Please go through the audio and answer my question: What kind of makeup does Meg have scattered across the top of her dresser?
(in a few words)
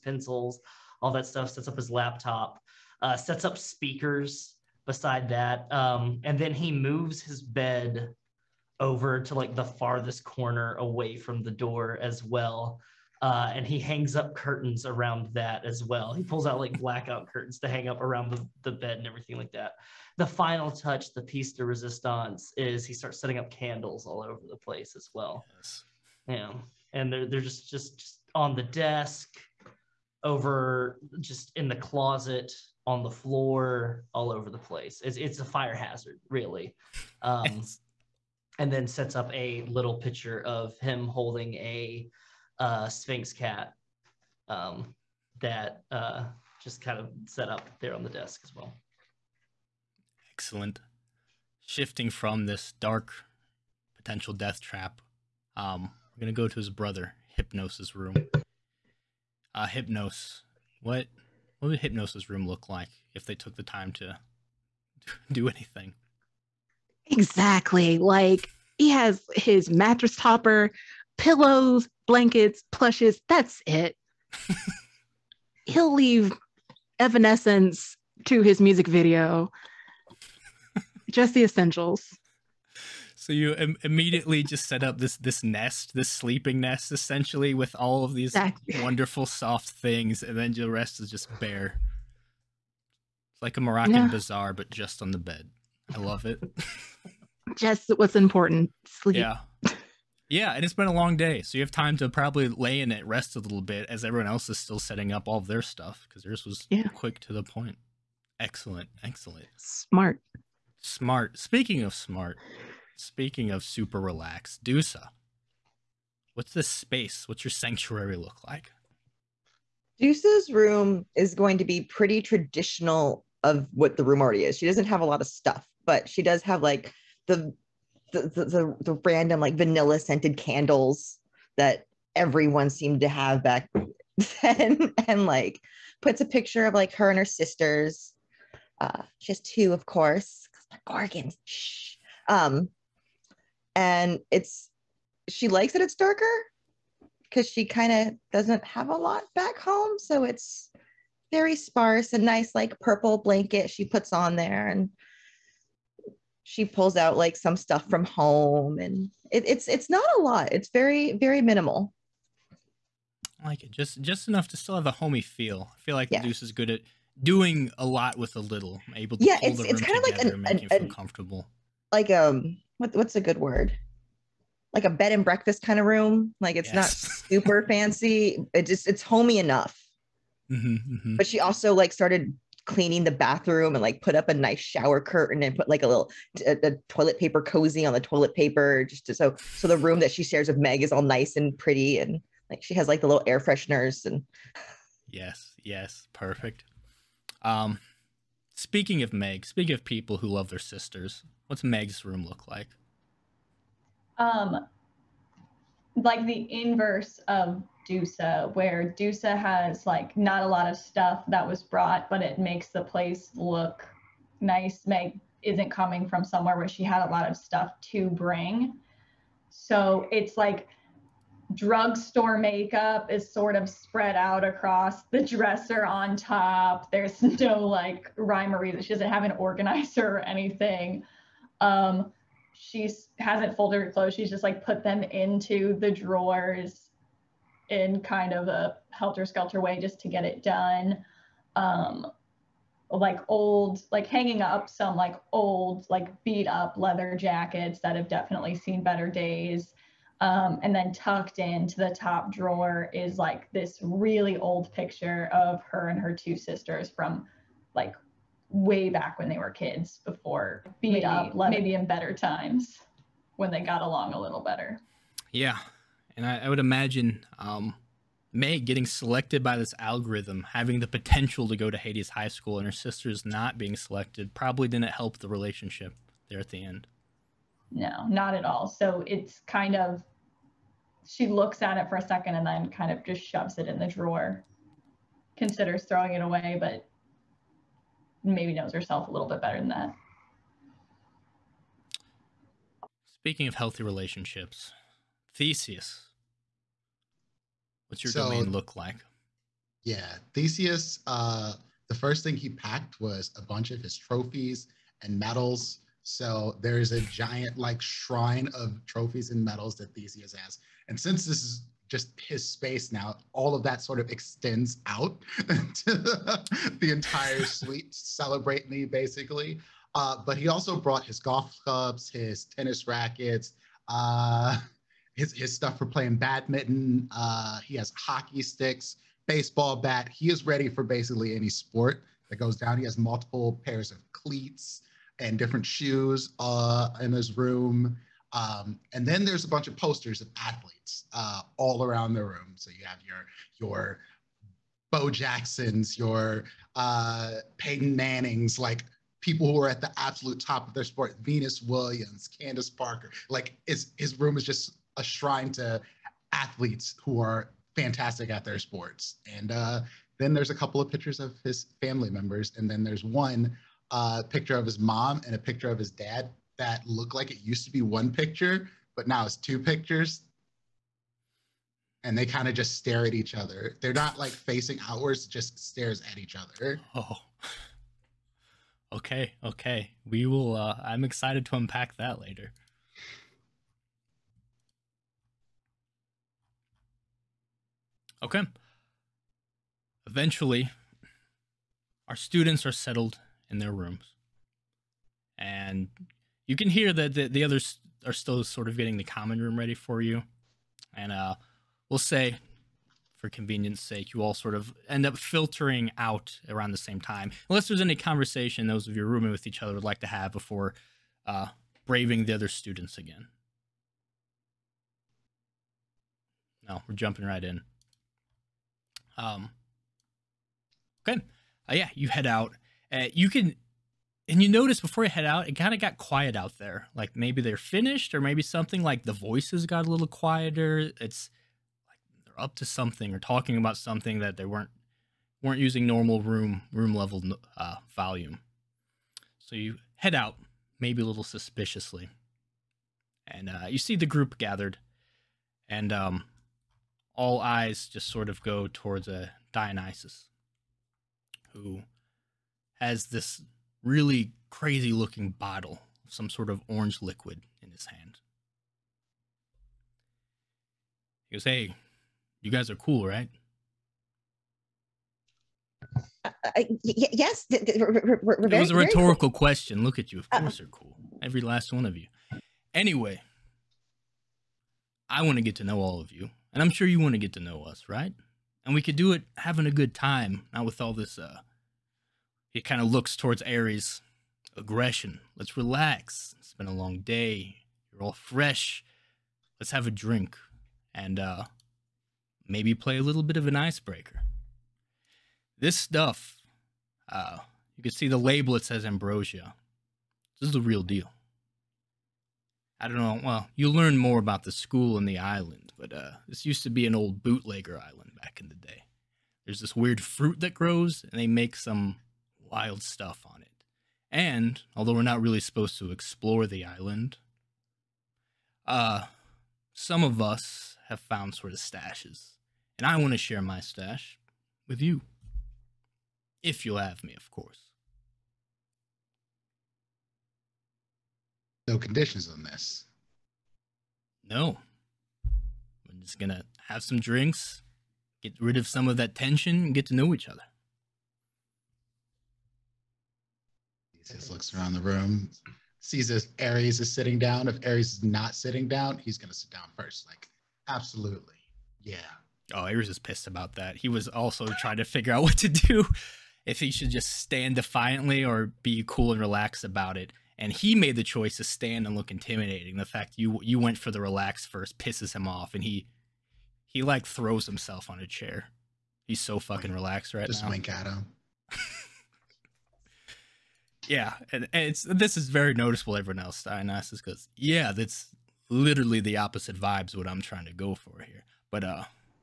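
drugstore makeup.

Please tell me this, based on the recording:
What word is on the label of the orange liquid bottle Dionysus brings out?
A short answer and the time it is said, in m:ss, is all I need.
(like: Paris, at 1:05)
ambrosia, at 8:18.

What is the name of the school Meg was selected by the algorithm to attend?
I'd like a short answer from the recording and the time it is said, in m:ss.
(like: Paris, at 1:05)
Hades High School, at 4:31.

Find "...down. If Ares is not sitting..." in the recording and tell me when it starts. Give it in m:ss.
9:07.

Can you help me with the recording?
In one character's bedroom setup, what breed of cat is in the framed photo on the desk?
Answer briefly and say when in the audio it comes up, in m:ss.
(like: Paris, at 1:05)
Sphynx, at 0:42.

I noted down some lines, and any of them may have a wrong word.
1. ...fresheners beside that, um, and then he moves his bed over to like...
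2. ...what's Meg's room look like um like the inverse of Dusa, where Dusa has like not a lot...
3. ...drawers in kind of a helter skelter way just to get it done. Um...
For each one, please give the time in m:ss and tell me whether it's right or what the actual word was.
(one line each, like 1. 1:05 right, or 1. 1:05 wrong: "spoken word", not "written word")
1. 0:03 wrong: "speakers", not "fresheners"
2. 3:21 right
3. 3:55 right.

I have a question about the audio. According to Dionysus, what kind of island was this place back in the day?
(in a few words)
old bootlegger island.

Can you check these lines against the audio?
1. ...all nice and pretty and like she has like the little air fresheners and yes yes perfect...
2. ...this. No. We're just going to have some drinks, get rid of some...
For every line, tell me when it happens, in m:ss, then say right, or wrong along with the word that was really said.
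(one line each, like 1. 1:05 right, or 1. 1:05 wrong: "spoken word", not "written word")
1. 3:10 right
2. 8:52 right.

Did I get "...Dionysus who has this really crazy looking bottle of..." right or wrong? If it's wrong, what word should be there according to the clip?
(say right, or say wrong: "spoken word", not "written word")
right.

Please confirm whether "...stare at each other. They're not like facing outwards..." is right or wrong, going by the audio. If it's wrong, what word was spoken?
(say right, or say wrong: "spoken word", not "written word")
right.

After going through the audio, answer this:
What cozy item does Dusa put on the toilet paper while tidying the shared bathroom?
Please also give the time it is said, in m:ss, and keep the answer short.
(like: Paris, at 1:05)
toilet paper cozy, at 3:06.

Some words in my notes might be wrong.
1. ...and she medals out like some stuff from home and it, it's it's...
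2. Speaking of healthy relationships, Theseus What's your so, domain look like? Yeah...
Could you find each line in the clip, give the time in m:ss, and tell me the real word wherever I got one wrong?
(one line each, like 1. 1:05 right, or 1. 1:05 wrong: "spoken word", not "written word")
1. 2:34 wrong: "pulls", not "medals"
2. 4:53 right.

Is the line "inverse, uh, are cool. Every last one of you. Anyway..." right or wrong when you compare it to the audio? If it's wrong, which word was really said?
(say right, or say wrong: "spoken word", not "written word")
wrong: "course", not "inverse".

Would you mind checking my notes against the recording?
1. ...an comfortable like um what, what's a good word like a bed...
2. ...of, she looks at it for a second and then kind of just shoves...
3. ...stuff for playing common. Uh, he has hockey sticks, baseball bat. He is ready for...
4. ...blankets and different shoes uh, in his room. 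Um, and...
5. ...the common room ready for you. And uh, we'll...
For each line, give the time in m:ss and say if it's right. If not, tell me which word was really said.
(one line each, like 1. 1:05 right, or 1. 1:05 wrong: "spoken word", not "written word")
1. 2:50 right
2. 4:39 right
3. 5:25 wrong: "badminton", not "common"
4. 5:34 wrong: "cleats", not "blankets"
5. 6:38 right.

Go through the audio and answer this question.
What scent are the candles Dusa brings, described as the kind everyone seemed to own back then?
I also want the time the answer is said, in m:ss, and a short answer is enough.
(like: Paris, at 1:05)
vanilla, at 2:09.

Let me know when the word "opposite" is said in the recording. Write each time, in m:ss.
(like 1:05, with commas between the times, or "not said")
9:39.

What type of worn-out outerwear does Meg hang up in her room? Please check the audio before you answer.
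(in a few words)
leather jackets.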